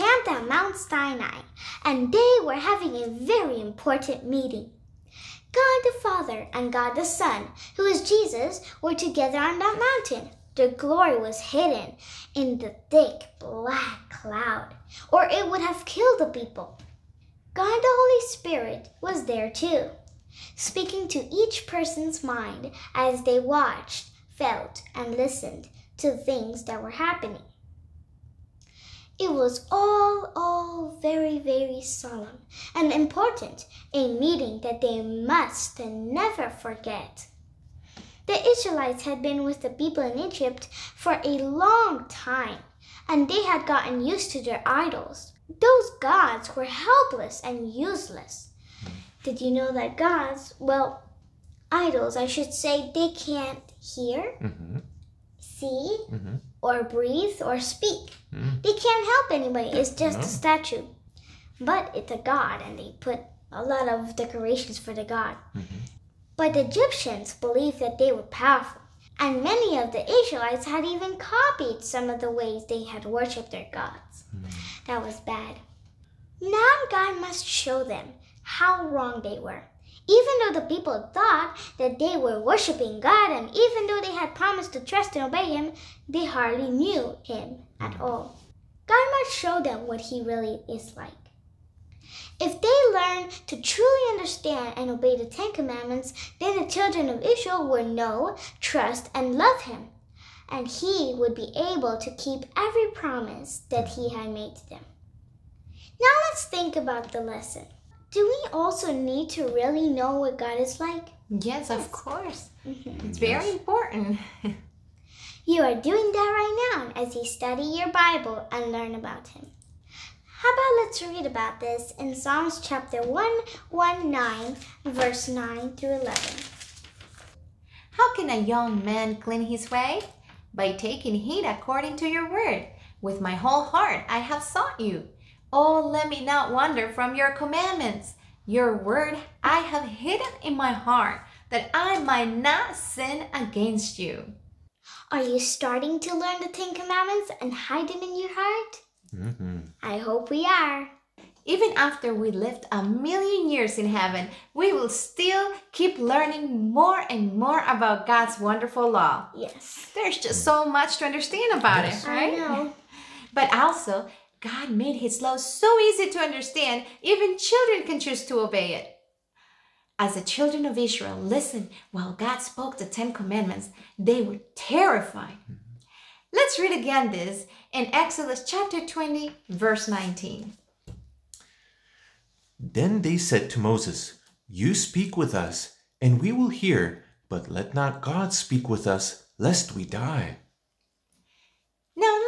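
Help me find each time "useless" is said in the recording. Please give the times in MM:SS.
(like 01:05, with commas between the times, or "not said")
00:47.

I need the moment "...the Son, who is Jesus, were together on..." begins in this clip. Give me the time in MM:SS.
00:06.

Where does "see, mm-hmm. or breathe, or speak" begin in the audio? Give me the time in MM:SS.
00:55.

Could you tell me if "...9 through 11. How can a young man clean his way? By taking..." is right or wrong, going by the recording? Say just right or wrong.
right.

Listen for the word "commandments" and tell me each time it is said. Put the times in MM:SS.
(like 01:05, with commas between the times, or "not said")
01:35, 02:17, 02:26, 02:53.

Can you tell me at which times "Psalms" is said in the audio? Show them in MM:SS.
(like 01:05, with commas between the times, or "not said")
02:02.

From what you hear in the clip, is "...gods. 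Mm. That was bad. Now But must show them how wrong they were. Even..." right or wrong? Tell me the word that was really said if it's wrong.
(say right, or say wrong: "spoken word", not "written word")
wrong: "God", not "But".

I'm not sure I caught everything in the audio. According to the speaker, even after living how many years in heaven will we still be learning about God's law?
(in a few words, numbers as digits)
1,000,000.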